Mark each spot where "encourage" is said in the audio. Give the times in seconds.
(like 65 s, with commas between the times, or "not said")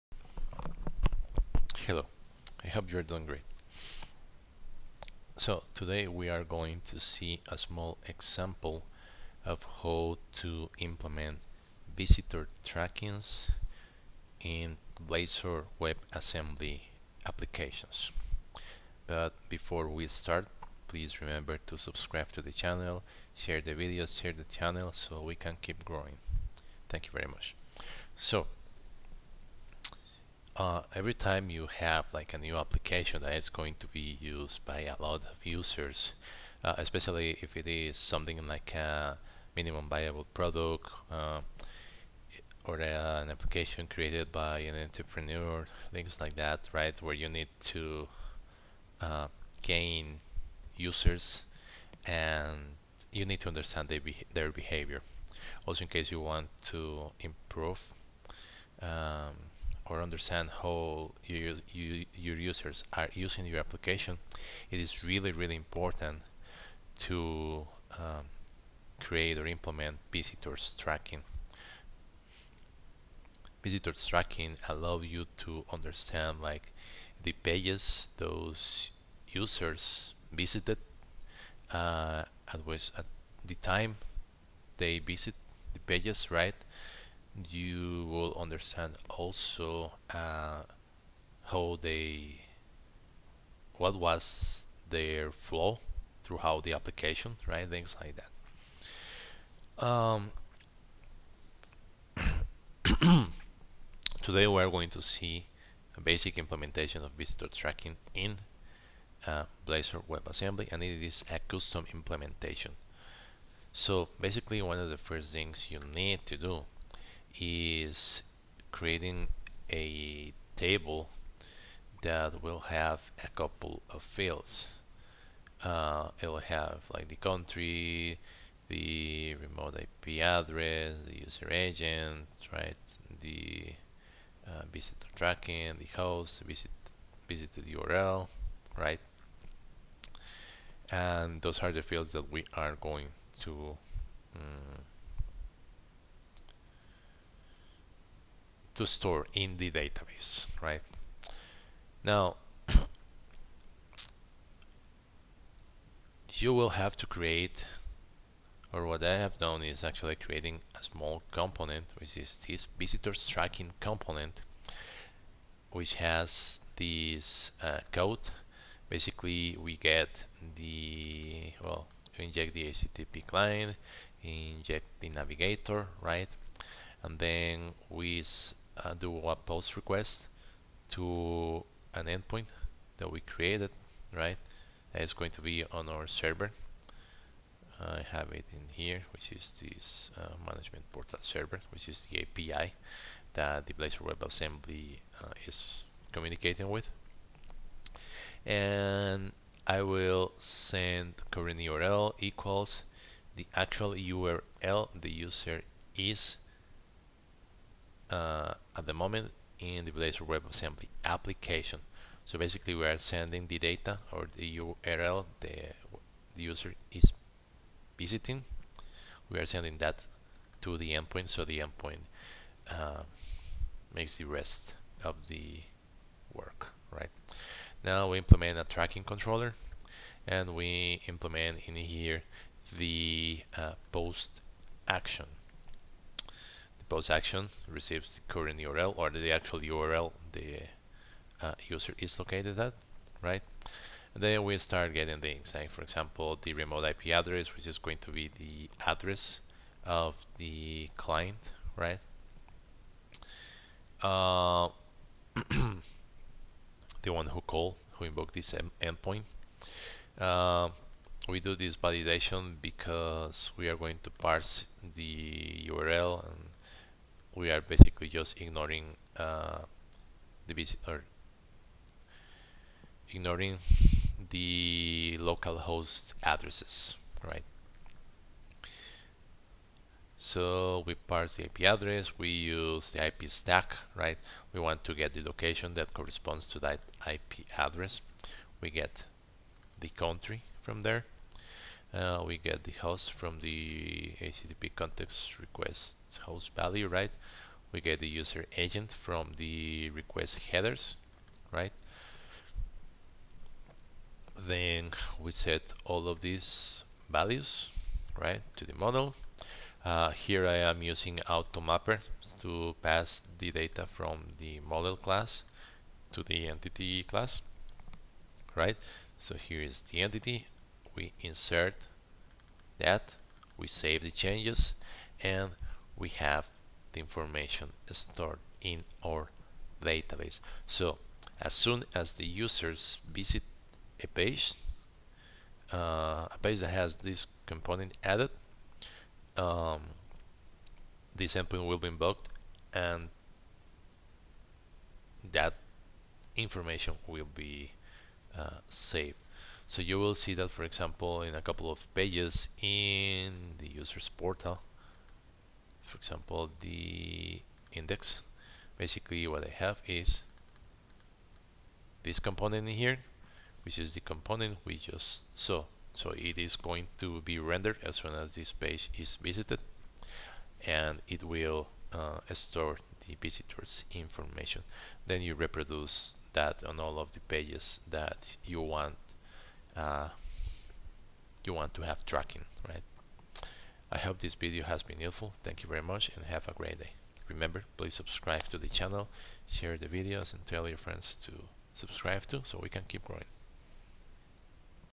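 not said.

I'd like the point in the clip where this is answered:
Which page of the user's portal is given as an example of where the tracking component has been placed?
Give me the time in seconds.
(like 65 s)
356 s.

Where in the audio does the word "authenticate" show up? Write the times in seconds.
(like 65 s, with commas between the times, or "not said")
not said.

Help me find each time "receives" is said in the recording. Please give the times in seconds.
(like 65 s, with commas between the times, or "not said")
237 s.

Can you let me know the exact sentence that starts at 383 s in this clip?
I hope this video has been helpful.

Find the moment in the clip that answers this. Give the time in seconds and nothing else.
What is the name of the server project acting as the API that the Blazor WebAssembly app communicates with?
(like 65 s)
190 s.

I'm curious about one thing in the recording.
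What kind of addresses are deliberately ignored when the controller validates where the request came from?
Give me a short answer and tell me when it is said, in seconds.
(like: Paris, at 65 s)
local host addresses, at 275 s.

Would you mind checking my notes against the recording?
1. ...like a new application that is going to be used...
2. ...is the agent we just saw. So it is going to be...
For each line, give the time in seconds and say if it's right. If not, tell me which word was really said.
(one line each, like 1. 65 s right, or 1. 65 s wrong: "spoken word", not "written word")
1. 32 s right
2. 363 s wrong: "component", not "agent".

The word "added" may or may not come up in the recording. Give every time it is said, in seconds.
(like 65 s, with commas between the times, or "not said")
338 s.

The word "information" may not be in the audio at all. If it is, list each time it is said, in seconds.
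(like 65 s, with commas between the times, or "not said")
326 s, 346 s, 373 s.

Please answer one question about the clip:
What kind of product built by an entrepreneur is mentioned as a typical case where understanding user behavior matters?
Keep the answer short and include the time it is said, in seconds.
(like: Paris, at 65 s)
minimum viable product, at 39 s.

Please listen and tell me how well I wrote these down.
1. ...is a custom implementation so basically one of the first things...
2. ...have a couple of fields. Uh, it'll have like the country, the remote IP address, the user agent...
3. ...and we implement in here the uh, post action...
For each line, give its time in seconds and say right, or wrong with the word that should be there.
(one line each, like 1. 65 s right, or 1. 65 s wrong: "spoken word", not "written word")
1. 111 s right
2. 122 s right
3. 230 s right.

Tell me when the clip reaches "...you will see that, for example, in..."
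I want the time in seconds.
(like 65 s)
349 s.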